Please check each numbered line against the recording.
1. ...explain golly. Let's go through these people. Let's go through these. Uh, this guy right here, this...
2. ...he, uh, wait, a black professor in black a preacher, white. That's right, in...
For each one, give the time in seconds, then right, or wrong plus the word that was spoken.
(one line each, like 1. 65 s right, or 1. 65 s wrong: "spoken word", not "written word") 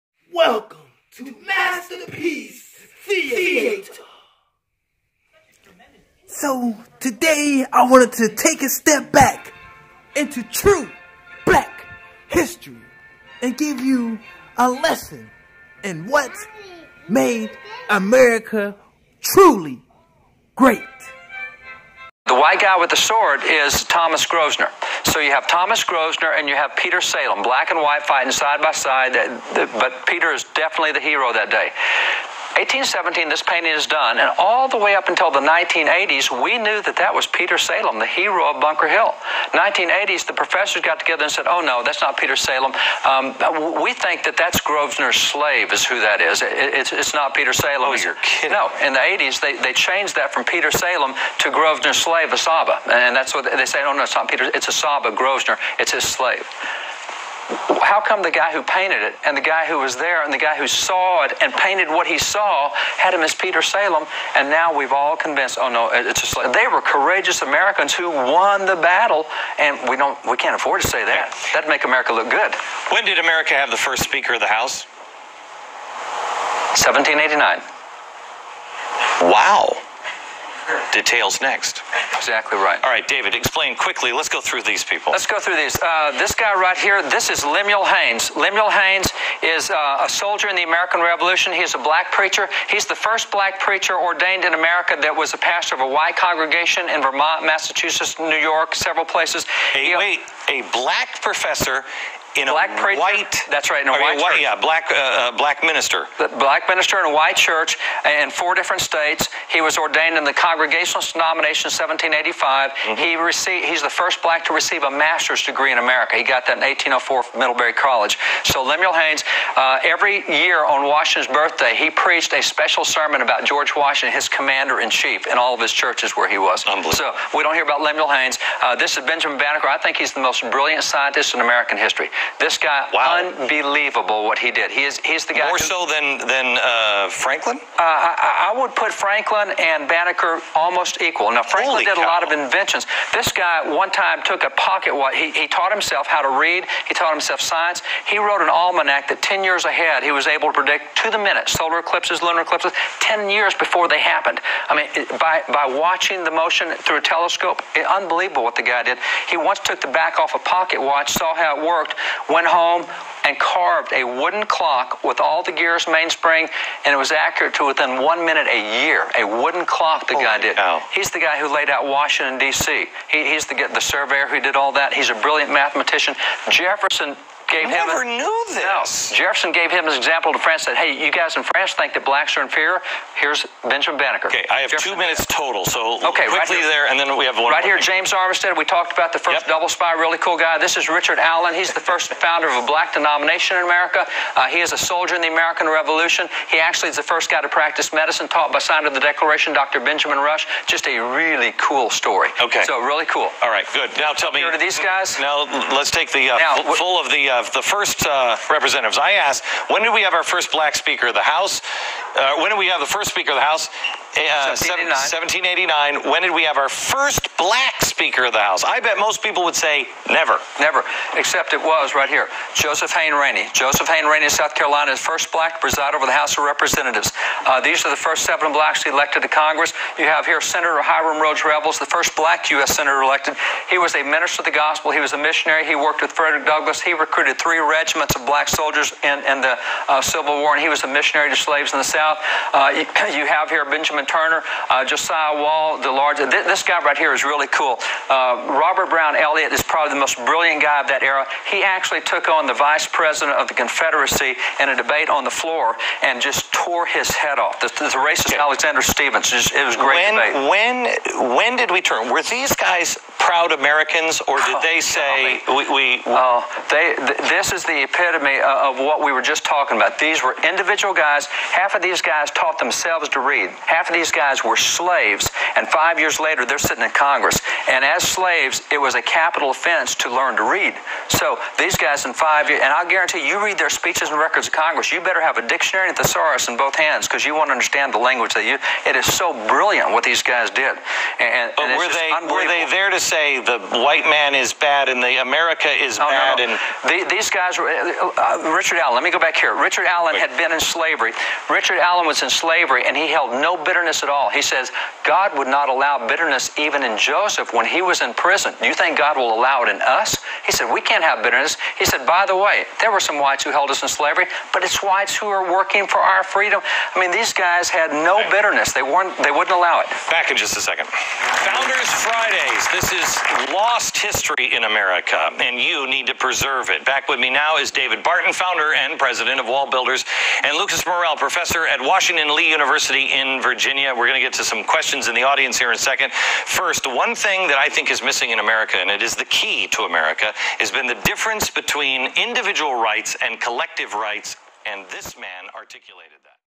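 1. 83 s wrong: "quickly", not "golly"
2. 99 s right.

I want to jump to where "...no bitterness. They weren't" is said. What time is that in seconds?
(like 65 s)
317 s.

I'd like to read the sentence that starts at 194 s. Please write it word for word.
Uh, he is a soldier in the American Revolution.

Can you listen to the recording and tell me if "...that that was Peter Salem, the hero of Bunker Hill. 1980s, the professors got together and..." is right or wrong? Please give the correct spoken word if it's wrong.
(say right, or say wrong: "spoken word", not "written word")
right.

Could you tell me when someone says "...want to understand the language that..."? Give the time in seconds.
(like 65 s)
287 s.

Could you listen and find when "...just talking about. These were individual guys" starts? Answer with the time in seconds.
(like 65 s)
269 s.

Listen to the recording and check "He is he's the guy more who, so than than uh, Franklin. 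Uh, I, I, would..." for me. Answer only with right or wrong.
right.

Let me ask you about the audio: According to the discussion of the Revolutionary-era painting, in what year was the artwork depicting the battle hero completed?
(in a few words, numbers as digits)
1817.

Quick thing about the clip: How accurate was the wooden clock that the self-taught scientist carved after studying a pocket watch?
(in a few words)
within one minute a year.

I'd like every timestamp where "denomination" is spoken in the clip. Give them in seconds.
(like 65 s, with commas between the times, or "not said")
111 s, 192 s.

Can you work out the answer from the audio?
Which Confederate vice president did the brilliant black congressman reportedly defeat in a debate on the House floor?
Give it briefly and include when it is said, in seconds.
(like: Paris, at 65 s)
Alexander Stephens, at 258 s.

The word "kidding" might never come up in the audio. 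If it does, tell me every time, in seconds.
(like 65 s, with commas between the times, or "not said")
48 s.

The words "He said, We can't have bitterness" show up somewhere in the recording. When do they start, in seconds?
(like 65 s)
310 s.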